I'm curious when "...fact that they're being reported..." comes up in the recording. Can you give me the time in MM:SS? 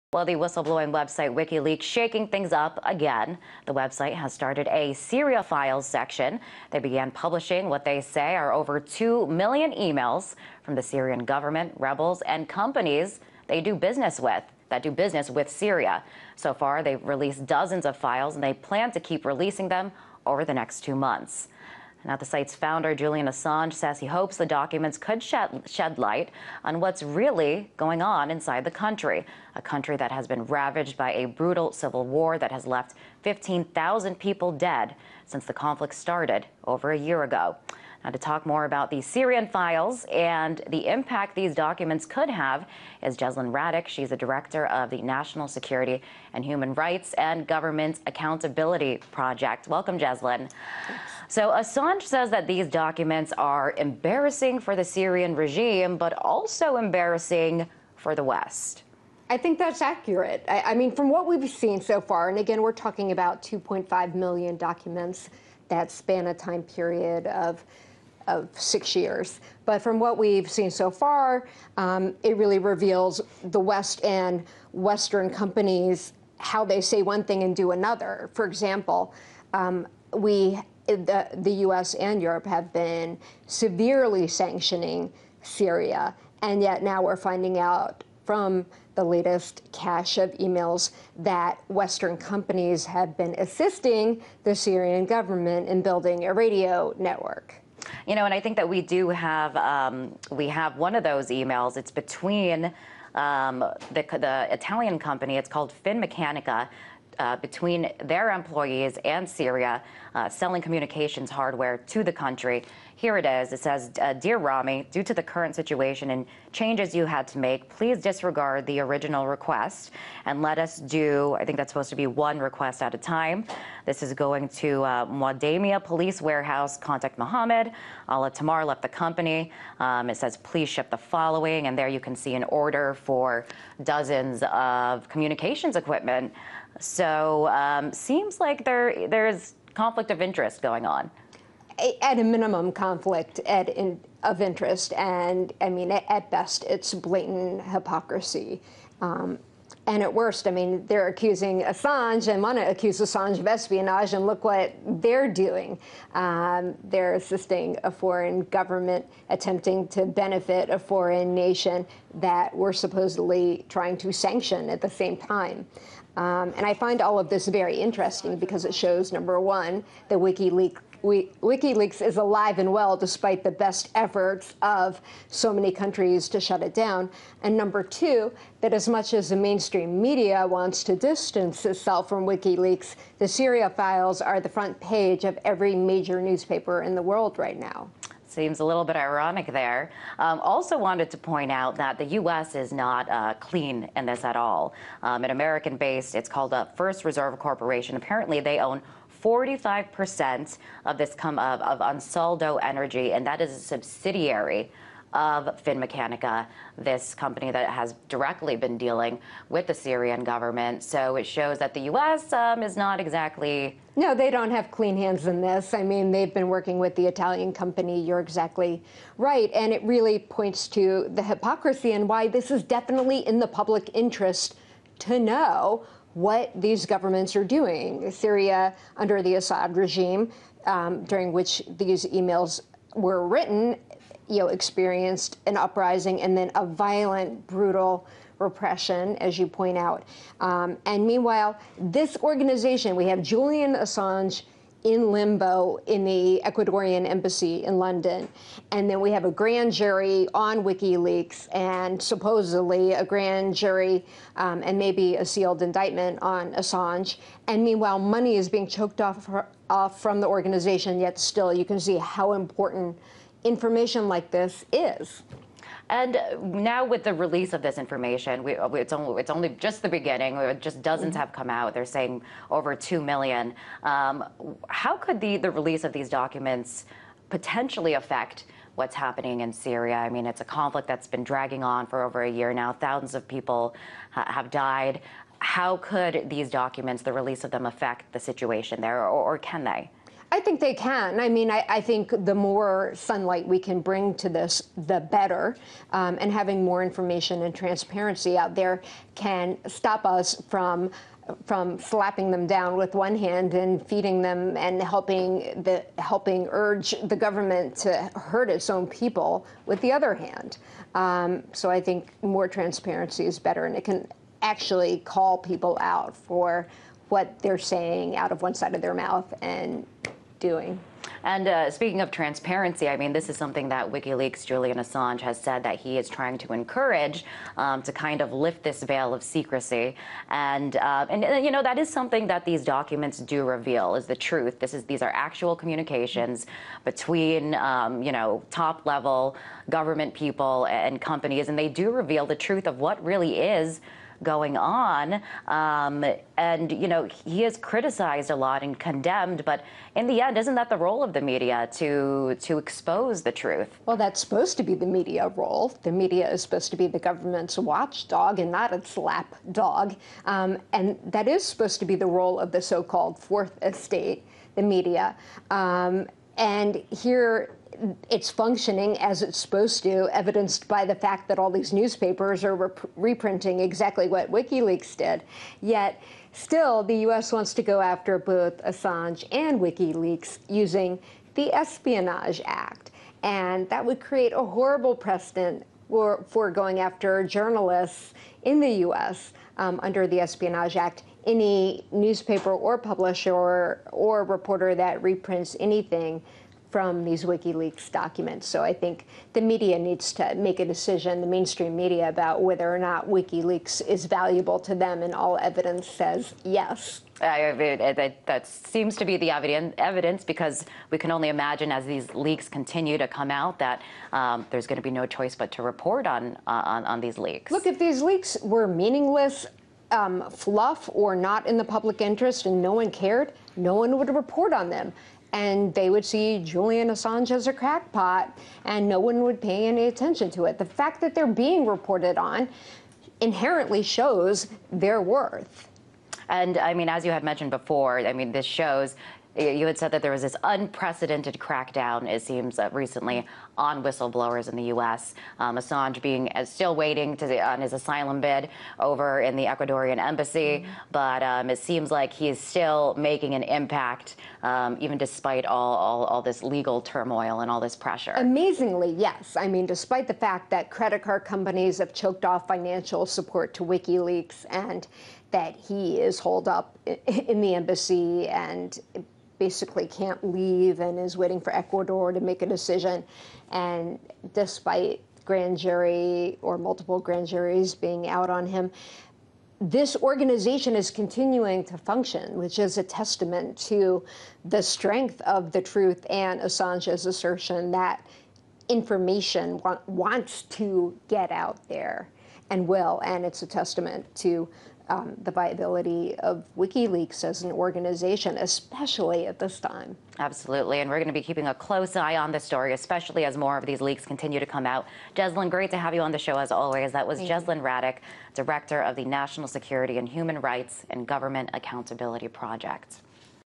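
07:10.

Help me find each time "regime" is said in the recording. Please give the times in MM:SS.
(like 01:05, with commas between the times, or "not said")
00:55, 03:49.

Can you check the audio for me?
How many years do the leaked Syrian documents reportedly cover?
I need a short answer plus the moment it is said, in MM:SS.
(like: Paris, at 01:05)
6 years, at 01:08.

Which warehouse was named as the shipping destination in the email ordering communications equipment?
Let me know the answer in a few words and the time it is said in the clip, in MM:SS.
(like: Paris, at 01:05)
Mwadamia Police Warehouse, at 02:05.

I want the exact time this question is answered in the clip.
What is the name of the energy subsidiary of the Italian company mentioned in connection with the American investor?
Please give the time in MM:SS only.
03:21.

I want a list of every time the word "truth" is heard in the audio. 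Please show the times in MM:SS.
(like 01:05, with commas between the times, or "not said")
05:34, 05:42, 05:53, 08:05.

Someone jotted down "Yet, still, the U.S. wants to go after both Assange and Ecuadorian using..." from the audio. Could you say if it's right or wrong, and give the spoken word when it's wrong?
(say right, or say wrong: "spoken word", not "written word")
wrong: "WikiLeaks", not "Ecuadorian".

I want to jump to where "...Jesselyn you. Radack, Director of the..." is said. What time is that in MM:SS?
08:27.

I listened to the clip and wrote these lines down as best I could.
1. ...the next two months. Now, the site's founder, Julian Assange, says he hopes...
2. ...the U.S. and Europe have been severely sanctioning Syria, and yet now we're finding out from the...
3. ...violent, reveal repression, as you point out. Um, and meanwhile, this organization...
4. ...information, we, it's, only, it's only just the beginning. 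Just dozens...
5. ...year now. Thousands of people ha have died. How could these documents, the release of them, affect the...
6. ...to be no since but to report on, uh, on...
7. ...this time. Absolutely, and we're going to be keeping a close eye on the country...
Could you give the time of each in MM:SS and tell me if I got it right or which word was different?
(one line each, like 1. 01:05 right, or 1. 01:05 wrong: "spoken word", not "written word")
1. 00:20 right
2. 01:21 right
3. 03:56 wrong: "brutal", not "reveal"
4. 04:27 right
5. 04:42 right
6. 06:54 wrong: "choice", not "since"
7. 08:19 wrong: "story", not "country".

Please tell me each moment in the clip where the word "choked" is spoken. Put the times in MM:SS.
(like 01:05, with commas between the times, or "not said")
04:18, 07:42.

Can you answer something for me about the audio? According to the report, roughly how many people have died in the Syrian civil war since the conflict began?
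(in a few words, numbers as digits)
15,000.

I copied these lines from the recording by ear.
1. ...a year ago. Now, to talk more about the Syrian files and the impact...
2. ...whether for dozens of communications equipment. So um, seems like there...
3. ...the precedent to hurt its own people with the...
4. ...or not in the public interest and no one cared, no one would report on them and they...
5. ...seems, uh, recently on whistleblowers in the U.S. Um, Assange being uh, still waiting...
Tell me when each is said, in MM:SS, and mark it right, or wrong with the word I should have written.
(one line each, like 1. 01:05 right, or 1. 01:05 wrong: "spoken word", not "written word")
1. 00:36 right
2. 02:12 wrong: "order", not "whether"
3. 05:07 wrong: "government", not "precedent"
4. 07:00 right
5. 07:22 right.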